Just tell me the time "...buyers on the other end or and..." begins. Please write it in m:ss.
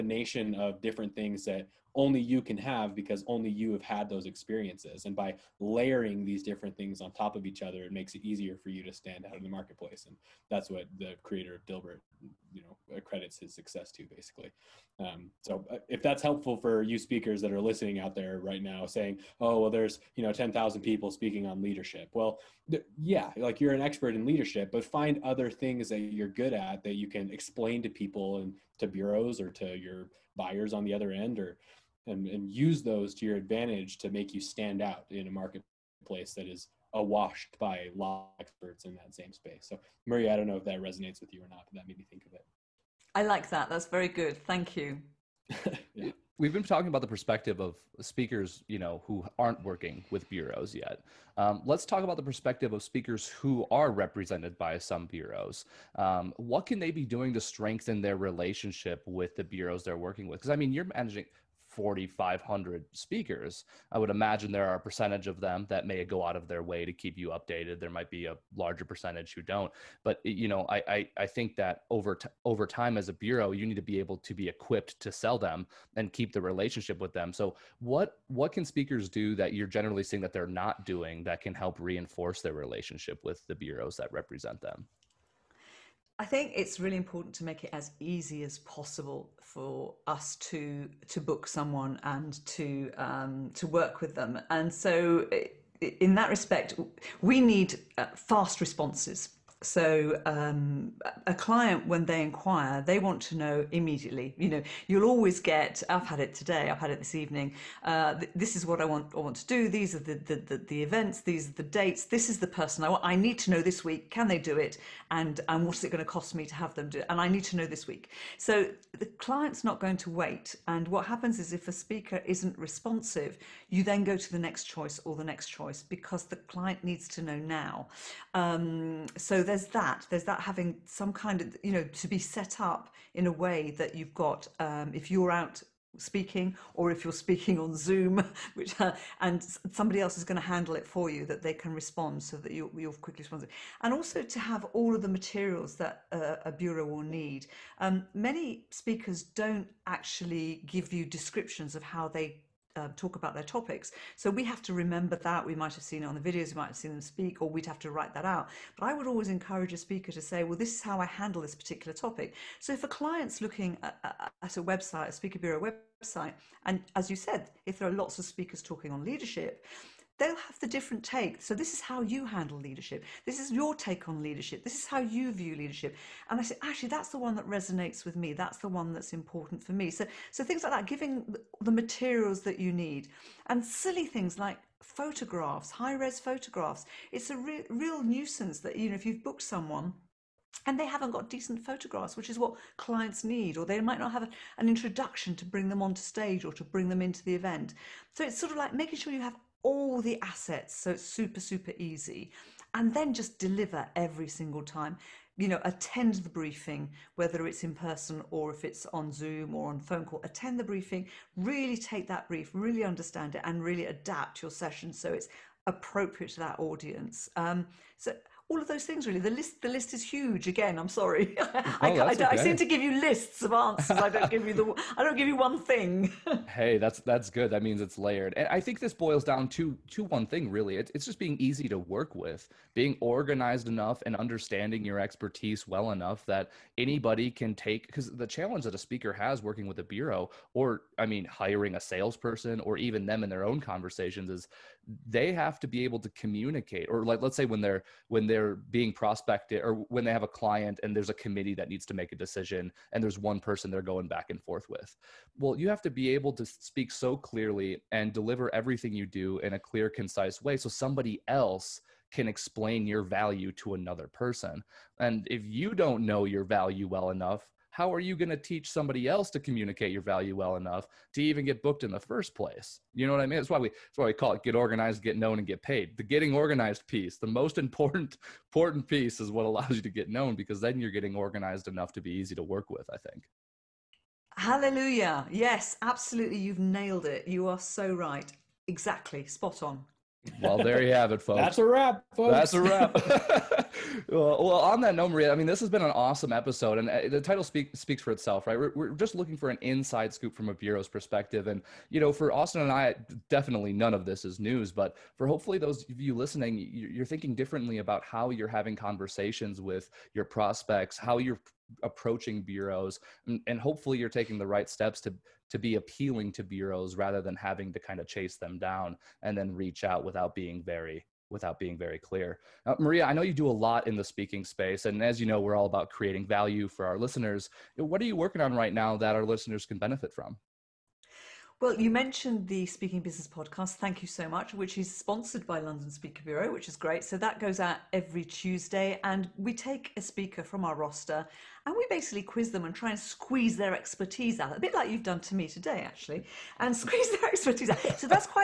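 0:30.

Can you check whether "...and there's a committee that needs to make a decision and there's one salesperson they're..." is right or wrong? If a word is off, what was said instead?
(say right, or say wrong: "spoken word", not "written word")
wrong: "person", not "salesperson".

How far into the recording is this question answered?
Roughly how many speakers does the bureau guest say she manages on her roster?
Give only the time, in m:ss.
1:01.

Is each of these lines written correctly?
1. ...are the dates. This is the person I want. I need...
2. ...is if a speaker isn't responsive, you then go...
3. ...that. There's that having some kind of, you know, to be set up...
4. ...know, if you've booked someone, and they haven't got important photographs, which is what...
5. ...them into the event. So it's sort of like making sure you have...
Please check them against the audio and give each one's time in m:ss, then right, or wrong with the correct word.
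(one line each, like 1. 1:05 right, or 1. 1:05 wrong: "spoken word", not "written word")
1. 1:51 right
2. 2:01 right
3. 2:09 right
4. 3:08 wrong: "decent", not "important"
5. 3:16 right.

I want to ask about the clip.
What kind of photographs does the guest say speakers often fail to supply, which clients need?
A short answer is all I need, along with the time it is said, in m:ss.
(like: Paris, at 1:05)
High res photographs, at 3:05.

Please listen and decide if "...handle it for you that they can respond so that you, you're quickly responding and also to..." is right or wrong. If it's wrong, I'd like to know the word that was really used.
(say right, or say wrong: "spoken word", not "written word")
right.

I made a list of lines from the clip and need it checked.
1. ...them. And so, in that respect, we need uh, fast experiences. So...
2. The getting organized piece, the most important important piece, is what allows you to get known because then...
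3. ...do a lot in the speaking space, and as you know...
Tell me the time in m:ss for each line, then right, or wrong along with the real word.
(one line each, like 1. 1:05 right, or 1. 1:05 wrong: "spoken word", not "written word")
1. 1:34 wrong: "responses", not "experiences"
2. 4:35 right
3. 5:23 right.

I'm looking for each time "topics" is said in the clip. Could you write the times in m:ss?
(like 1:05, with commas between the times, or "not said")
2:33, 2:41.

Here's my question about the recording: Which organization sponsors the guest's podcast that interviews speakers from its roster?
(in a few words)
London Speaker Bureau.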